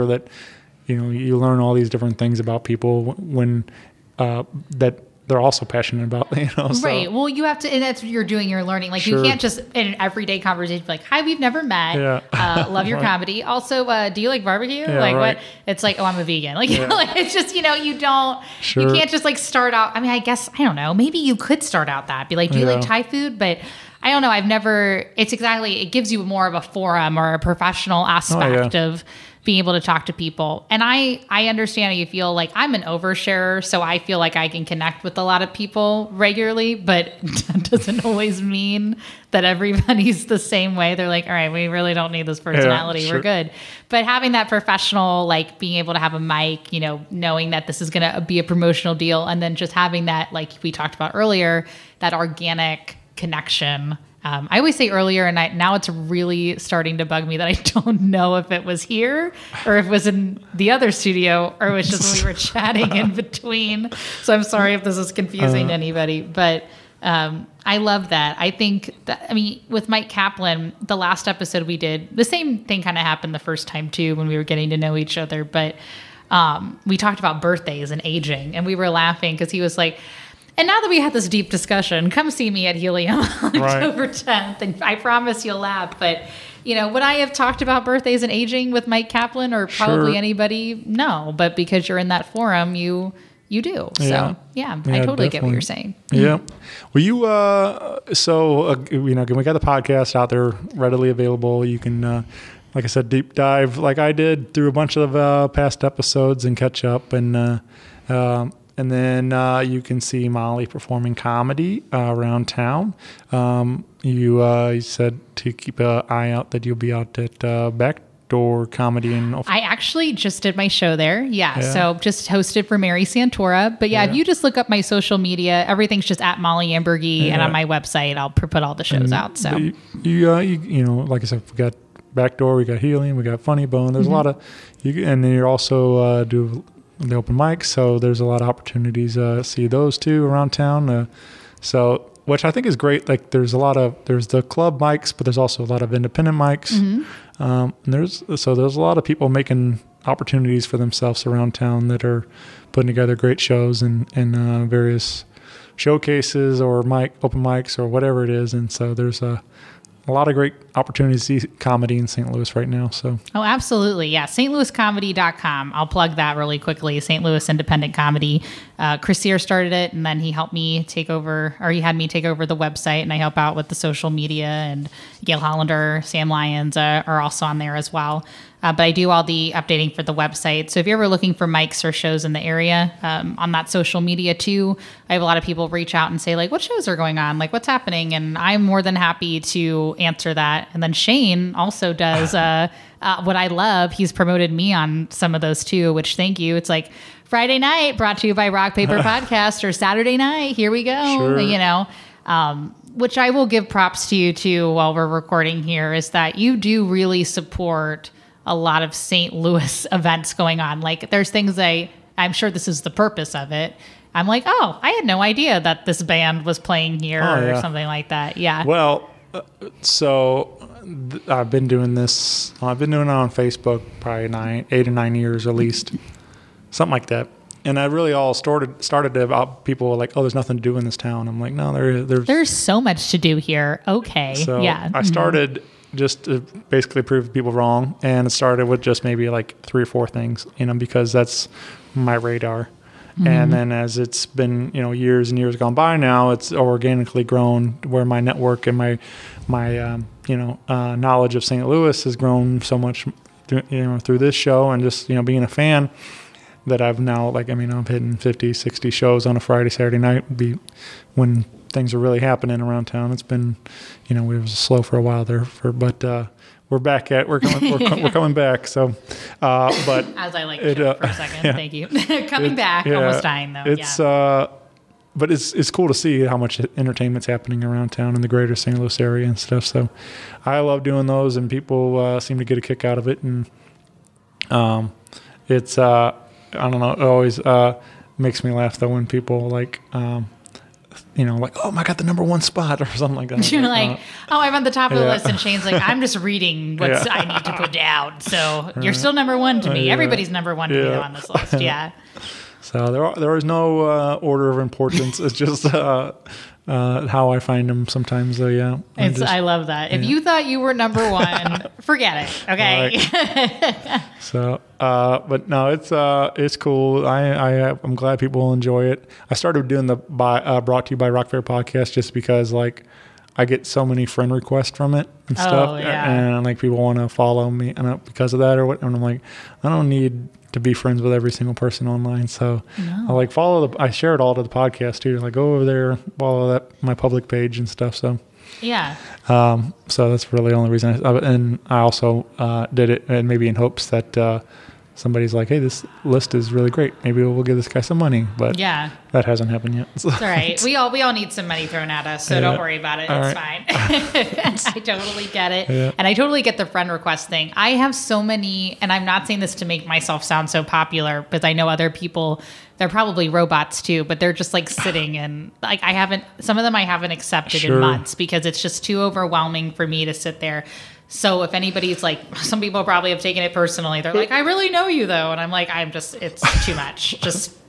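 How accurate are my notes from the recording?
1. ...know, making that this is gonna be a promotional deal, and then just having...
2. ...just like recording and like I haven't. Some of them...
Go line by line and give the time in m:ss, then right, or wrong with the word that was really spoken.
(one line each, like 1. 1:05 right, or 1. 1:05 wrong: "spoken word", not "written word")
1. 0:46 wrong: "knowing", not "making"
2. 6:04 wrong: "sitting", not "recording".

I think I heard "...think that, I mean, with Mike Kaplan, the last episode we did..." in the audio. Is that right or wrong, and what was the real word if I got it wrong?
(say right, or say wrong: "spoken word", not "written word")
right.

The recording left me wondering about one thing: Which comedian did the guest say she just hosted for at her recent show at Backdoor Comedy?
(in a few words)
Mary Santora.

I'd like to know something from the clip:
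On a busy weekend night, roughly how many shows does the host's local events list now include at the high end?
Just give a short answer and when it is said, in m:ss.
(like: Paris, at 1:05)
60, at 4:18.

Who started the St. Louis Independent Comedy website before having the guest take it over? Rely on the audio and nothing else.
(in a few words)
Chris Sear.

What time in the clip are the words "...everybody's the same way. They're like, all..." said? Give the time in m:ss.
0:39.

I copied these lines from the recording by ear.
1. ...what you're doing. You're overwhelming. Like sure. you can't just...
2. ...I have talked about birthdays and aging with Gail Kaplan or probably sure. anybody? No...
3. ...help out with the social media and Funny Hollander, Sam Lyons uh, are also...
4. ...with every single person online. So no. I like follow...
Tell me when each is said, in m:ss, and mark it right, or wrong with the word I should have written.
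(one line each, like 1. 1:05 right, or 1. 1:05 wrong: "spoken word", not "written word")
1. 0:08 wrong: "learning", not "overwhelming"
2. 1:27 wrong: "Mike", not "Gail"
3. 2:53 wrong: "Gail", not "Funny"
4. 5:31 right.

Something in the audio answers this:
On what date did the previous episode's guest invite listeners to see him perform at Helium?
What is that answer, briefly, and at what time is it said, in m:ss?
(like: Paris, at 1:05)
October 10th, at 1:23.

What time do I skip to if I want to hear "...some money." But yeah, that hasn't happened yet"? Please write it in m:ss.
5:47.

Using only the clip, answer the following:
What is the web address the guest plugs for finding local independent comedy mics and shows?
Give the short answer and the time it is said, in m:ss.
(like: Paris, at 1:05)
stlouiscomedy.com, at 2:44.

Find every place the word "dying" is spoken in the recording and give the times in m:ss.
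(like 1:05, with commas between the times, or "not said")
4:33.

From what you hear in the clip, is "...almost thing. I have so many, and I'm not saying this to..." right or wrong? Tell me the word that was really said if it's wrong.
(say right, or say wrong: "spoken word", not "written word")
wrong: "request", not "almost".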